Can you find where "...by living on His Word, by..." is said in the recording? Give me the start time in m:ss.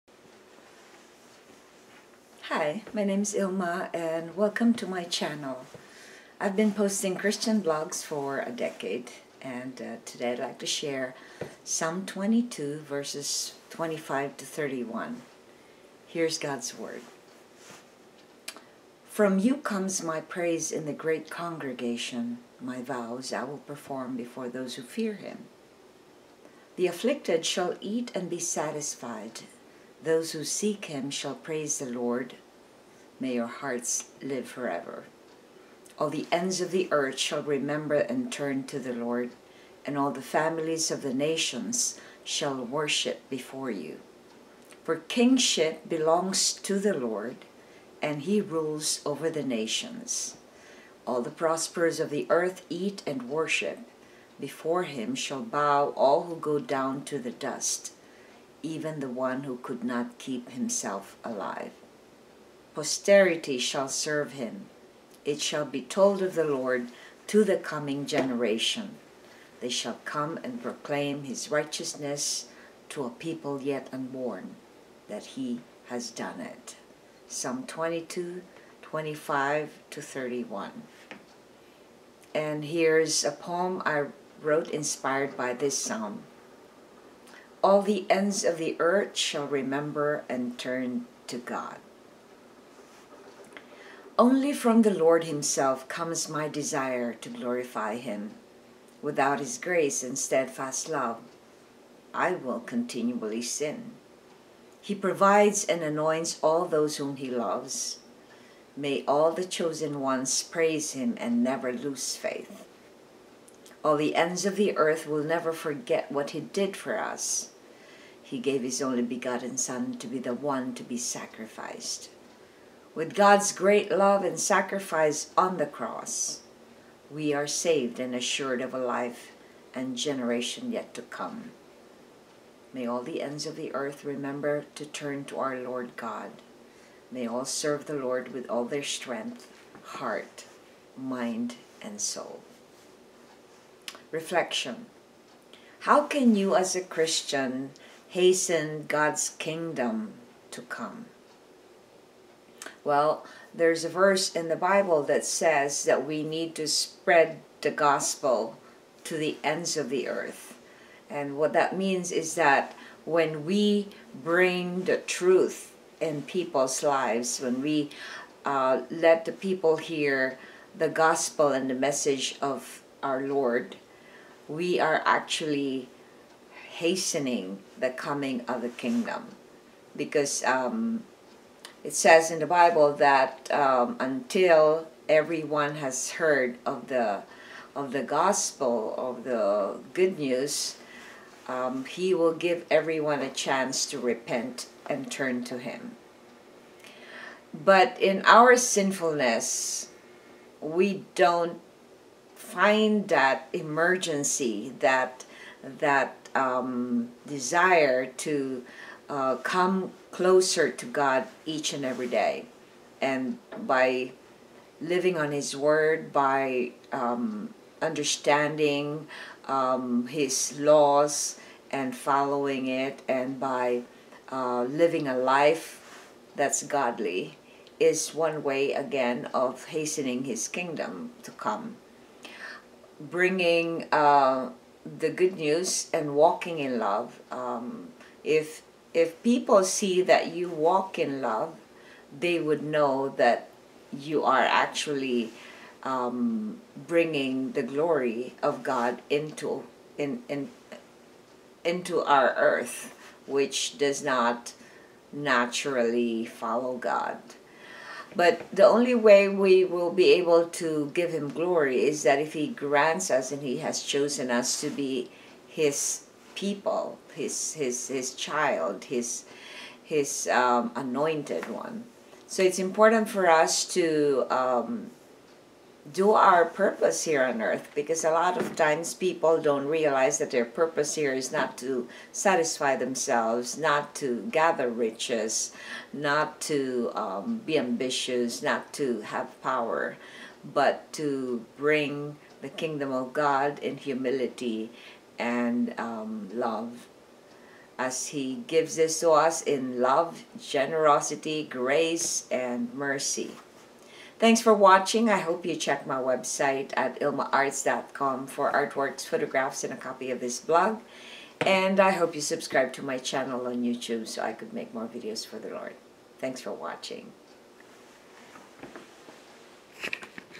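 3:33.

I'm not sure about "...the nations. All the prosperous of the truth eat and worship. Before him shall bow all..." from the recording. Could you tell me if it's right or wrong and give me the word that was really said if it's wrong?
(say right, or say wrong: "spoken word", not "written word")
wrong: "earth", not "truth".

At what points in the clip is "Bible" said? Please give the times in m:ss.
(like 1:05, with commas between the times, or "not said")
2:34, 3:02.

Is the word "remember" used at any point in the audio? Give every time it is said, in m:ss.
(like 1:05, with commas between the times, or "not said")
0:37, 1:29, 2:14.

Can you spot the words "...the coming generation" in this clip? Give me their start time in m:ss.
1:07.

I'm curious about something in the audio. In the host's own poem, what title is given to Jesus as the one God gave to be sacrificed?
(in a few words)
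only begotten Son.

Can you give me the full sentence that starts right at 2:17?
May all serve the Lord with all their strength, heart, mind, and soul.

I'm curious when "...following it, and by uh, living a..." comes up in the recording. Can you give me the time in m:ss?
3:41.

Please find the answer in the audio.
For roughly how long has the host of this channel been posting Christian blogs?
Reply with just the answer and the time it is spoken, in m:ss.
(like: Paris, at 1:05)
a decade, at 0:08.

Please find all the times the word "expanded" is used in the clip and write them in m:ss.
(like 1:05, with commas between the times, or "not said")
not said.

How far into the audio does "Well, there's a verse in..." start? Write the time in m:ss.
2:32.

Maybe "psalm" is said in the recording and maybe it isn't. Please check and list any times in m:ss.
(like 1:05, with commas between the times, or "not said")
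0:11, 1:17, 1:25.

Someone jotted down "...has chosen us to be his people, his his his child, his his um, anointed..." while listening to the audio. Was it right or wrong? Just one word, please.
right.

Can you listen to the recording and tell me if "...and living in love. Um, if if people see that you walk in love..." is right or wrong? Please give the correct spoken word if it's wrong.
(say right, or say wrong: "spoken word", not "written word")
wrong: "walking", not "living".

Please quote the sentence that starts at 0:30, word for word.
Those who seek him shall praise the Lord.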